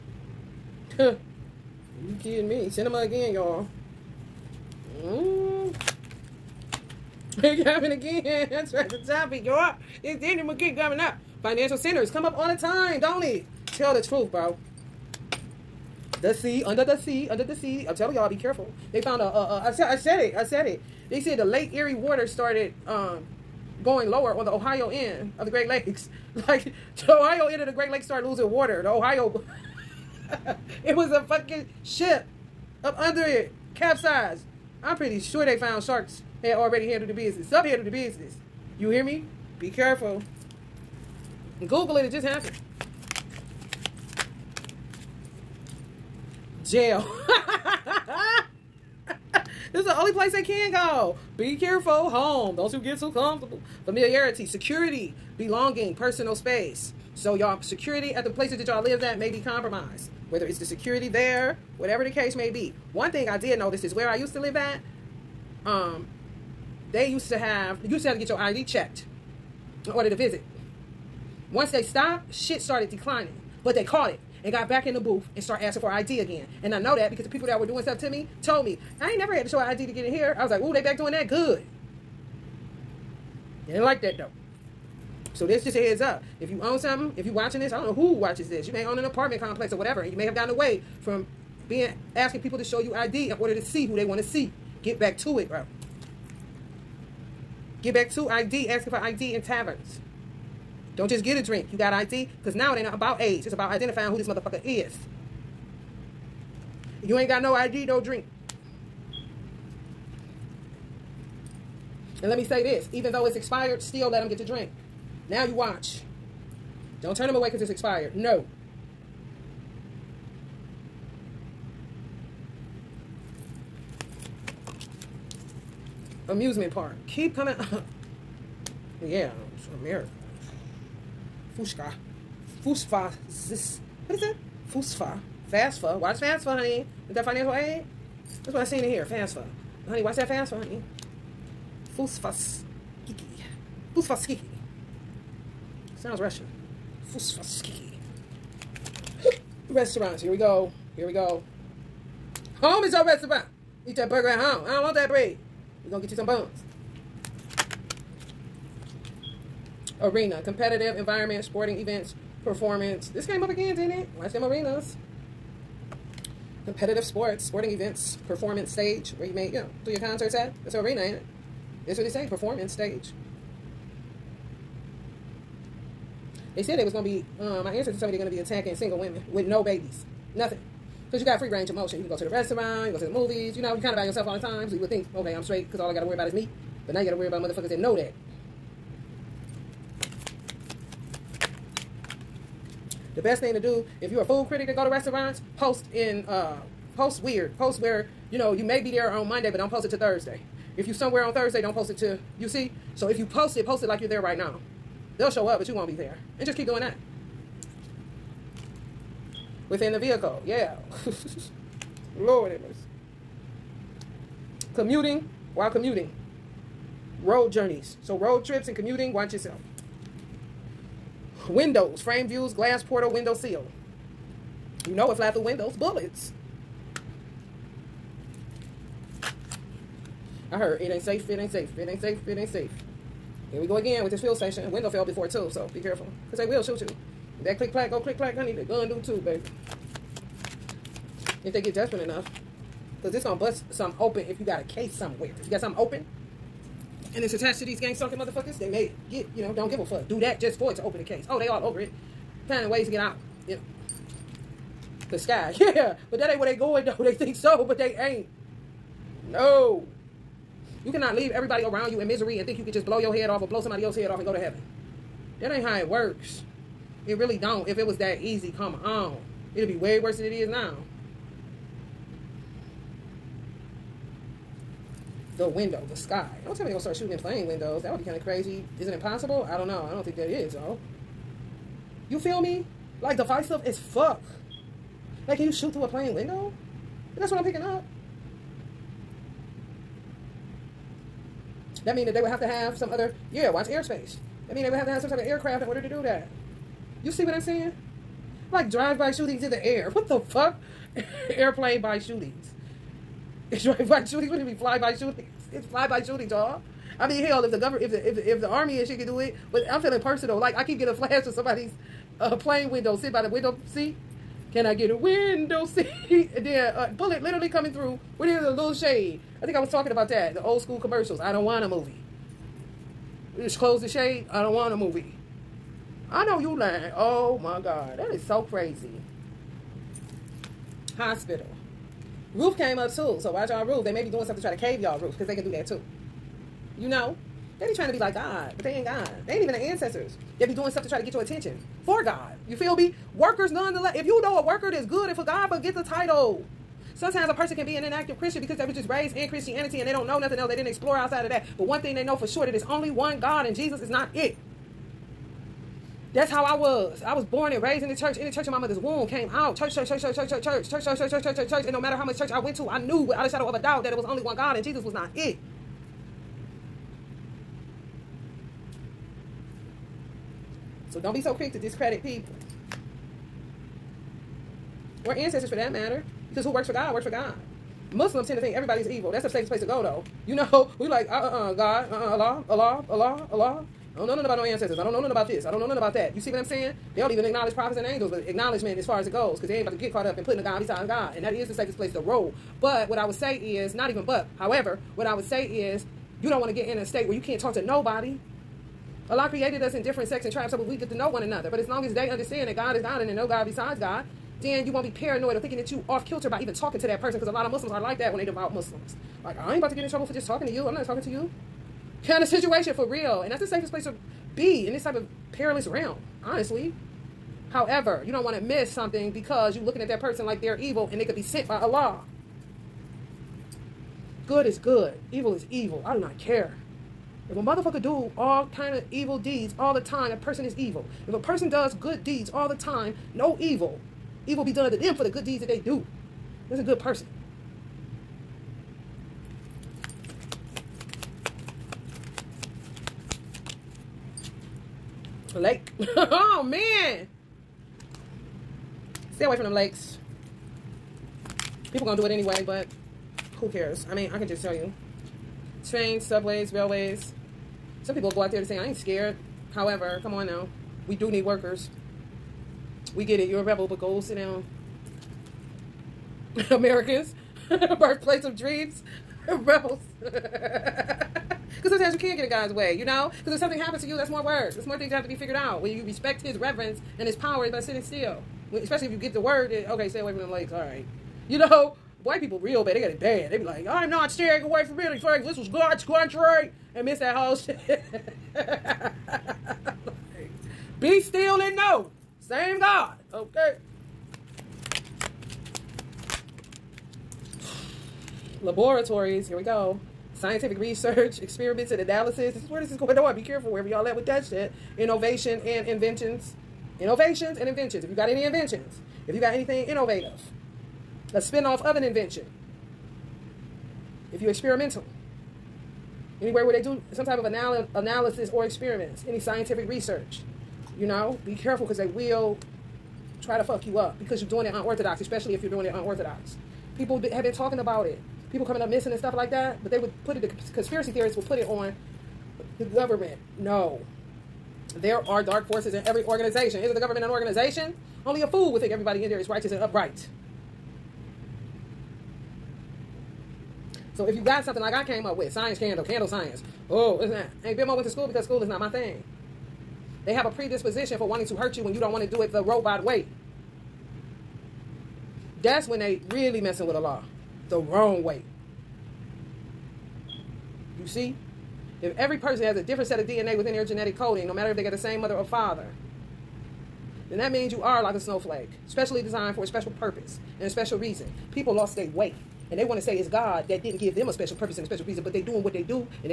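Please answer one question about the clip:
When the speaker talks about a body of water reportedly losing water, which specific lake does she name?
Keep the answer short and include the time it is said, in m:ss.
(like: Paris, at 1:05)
Lake Erie, at 0:21.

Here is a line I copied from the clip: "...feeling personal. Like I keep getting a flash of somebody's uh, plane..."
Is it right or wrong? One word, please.
right.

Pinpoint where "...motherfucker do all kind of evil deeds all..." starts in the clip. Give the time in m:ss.
7:07.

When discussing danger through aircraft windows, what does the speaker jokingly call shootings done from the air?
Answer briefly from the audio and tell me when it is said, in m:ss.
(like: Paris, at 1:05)
fly-by shootings, at 5:04.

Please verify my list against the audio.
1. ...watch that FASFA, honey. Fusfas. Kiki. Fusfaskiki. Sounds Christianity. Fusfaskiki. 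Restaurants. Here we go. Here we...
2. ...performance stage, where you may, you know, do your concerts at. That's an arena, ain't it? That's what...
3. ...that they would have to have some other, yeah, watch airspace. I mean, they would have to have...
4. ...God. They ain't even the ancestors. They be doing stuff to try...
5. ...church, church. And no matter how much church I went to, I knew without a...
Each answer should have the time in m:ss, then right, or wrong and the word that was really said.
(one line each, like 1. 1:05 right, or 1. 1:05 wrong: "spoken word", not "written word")
1. 2:20 wrong: "Russian", not "Christianity"
2. 2:48 right
3. 4:52 right
4. 5:38 right
5. 6:01 right.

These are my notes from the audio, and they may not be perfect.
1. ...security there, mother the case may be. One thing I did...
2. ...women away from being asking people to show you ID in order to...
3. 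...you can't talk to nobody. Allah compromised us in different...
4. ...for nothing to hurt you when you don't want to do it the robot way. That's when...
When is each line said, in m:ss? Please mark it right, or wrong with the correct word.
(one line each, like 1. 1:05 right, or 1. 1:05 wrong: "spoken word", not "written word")
1. 1:00 wrong: "whatever", not "mother"
2. 1:30 wrong: "gotten", not "women"
3. 6:37 wrong: "created", not "compromised"
4. 9:10 wrong: "wanting", not "nothing".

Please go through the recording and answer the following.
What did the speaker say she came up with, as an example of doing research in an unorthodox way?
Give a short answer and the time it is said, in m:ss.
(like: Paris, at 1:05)
candle science, at 9:05.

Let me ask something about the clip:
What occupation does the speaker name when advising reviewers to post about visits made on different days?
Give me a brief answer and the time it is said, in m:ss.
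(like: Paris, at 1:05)
food critic, at 3:14.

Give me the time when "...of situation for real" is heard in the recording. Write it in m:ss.
6:52.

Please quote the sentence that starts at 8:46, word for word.
People have been talking about it.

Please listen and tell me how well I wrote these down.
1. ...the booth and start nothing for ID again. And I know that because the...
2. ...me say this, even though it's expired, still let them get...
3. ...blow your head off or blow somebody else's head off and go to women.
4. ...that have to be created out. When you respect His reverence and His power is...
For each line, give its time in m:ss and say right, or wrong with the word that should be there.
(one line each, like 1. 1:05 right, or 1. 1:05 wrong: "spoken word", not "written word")
1. 1:14 wrong: "asking", not "nothing"
2. 1:52 right
3. 4:22 wrong: "heaven", not "women"
4. 7:54 wrong: "figured", not "created".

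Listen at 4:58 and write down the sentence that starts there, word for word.
Like drive-by shootings in the air.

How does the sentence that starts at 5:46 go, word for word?
Sometimes a person can be an inactive Christian because they were just raised in Christianity and they don't know nothing else.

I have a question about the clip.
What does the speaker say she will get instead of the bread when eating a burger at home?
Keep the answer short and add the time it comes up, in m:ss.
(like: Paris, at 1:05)
buns, at 2:36.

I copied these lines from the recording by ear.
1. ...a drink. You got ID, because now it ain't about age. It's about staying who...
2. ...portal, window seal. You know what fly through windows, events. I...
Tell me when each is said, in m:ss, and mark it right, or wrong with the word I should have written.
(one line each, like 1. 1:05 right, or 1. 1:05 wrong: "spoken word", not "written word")
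1. 1:41 wrong: "identifying", not "staying"
2. 3:42 wrong: "bullets", not "events".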